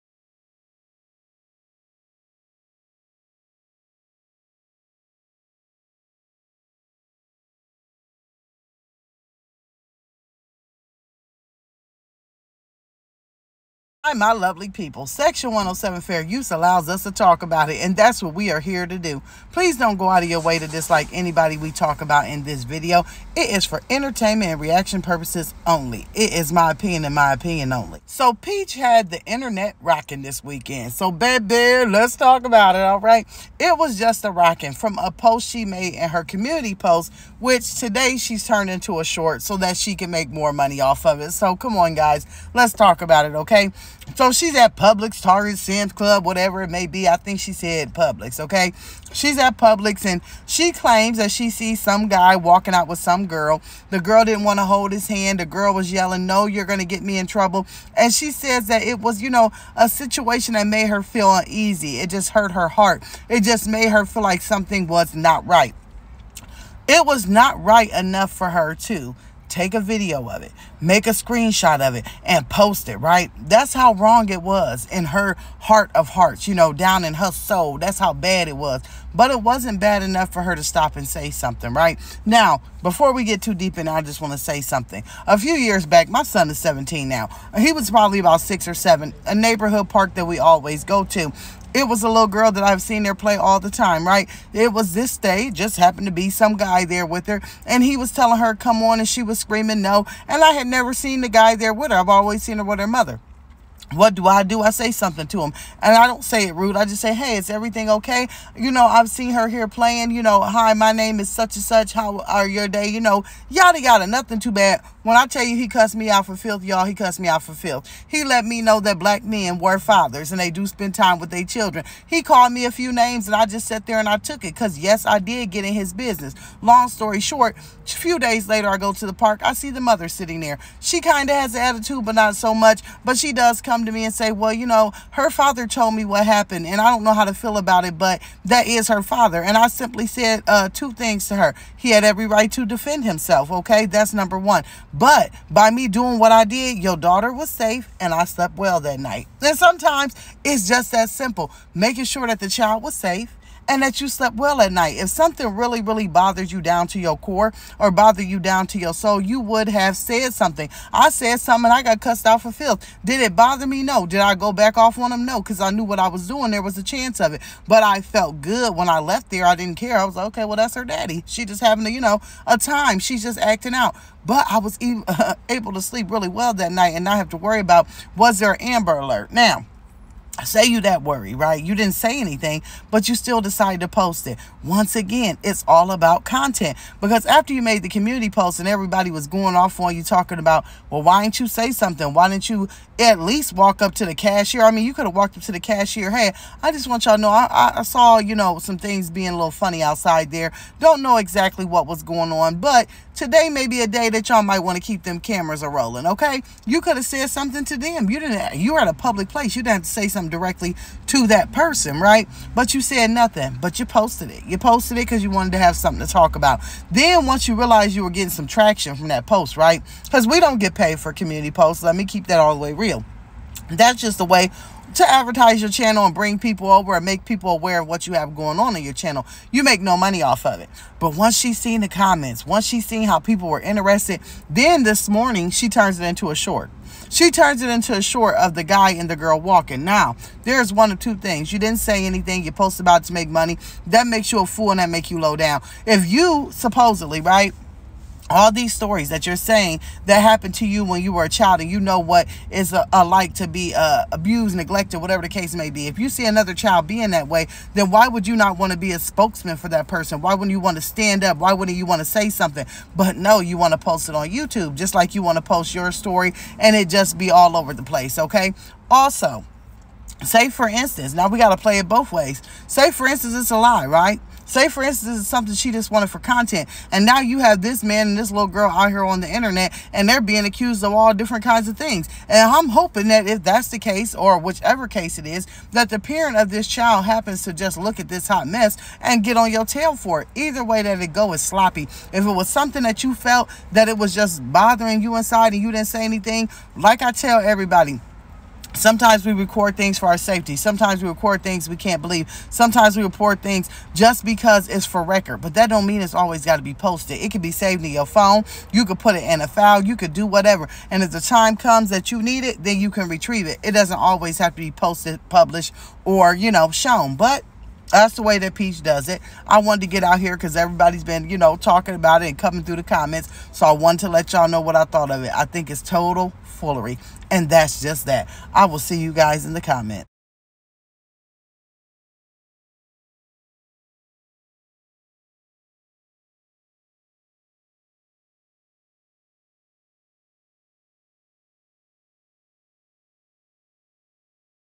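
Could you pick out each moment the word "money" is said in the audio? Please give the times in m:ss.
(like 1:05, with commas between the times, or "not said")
0:40, 3:49, 4:03.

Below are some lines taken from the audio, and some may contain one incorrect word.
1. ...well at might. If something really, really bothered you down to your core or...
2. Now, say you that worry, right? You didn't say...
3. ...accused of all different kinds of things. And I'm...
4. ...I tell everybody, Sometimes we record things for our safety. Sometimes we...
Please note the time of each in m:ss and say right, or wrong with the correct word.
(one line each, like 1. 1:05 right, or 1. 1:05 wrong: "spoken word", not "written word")
1. 2:34 wrong: "night", not "might"
2. 2:59 right
3. 4:40 right
4. 4:57 right.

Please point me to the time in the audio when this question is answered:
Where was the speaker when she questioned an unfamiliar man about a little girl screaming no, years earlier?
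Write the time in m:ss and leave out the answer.
1:29.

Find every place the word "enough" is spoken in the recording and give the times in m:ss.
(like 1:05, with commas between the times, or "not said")
1:07, 1:20.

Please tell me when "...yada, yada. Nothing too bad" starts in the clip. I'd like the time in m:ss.
1:53.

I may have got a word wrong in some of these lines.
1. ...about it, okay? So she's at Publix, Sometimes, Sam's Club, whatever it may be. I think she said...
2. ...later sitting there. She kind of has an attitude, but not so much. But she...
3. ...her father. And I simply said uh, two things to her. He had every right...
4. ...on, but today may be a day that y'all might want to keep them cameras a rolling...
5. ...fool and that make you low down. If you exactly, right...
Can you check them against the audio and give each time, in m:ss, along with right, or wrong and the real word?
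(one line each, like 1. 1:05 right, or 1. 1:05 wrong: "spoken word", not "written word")
1. 0:43 wrong: "Target", not "Sometimes"
2. 2:09 wrong: "mother", not "later"
3. 2:18 right
4. 3:22 right
5. 4:04 wrong: "supposedly", not "exactly".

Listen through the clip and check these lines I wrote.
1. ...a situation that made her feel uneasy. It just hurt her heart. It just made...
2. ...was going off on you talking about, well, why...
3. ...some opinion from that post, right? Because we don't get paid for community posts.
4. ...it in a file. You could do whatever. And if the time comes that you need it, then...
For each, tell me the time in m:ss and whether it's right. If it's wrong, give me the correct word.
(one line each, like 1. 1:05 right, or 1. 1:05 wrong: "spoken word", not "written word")
1. 0:59 right
2. 3:09 right
3. 3:38 wrong: "traction", not "opinion"
4. 5:09 right.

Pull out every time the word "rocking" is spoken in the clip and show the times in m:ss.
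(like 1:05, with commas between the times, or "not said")
0:29, 0:34.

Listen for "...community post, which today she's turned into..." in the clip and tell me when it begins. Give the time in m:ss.
0:36.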